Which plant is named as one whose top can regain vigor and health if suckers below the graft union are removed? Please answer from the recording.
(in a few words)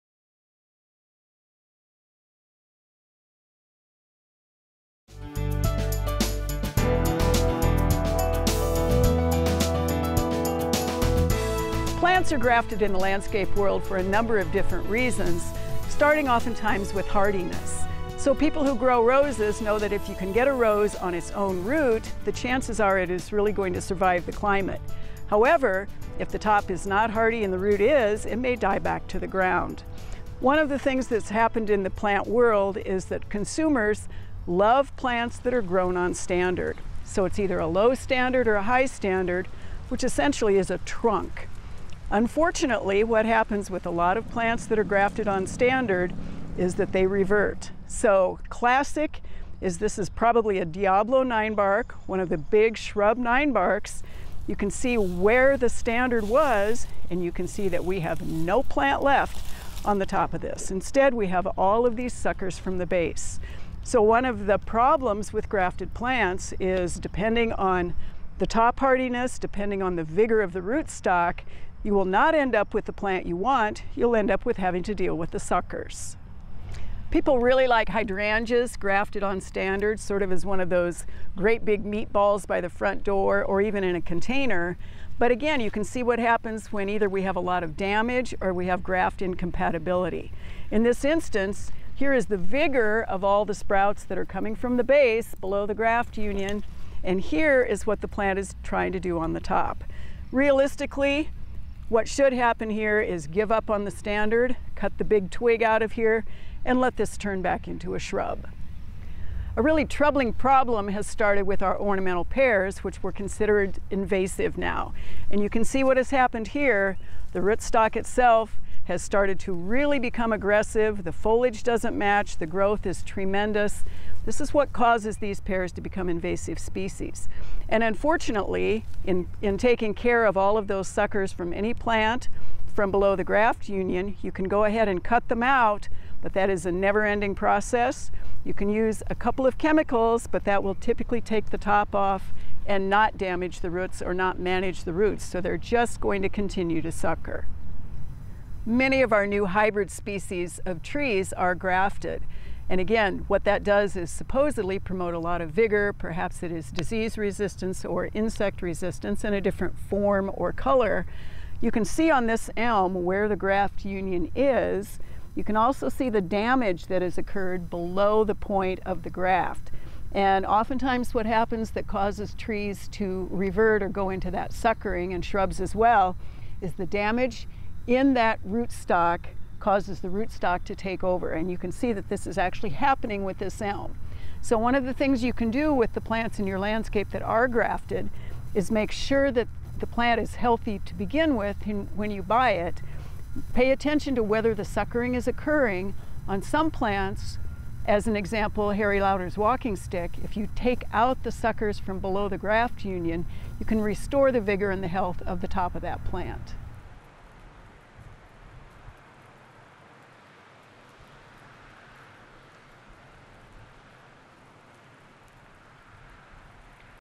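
Harry Lauder's walking stick.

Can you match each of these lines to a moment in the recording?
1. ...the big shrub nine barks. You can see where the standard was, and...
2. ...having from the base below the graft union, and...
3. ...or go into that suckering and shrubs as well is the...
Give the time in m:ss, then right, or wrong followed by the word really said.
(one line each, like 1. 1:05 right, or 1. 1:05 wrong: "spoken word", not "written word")
1. 0:52 right
2. 1:34 wrong: "coming", not "having"
3. 2:53 right.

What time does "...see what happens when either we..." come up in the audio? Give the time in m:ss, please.
1:25.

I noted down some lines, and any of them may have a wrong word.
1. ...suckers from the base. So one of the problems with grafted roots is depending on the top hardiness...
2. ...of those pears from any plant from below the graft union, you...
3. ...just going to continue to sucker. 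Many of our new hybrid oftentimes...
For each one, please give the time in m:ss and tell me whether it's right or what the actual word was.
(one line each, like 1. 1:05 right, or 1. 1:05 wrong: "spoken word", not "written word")
1. 1:02 wrong: "plants", not "roots"
2. 2:10 wrong: "suckers", not "pears"
3. 2:25 wrong: "species", not "oftentimes".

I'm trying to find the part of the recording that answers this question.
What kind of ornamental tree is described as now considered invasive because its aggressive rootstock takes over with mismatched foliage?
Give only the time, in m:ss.
1:51.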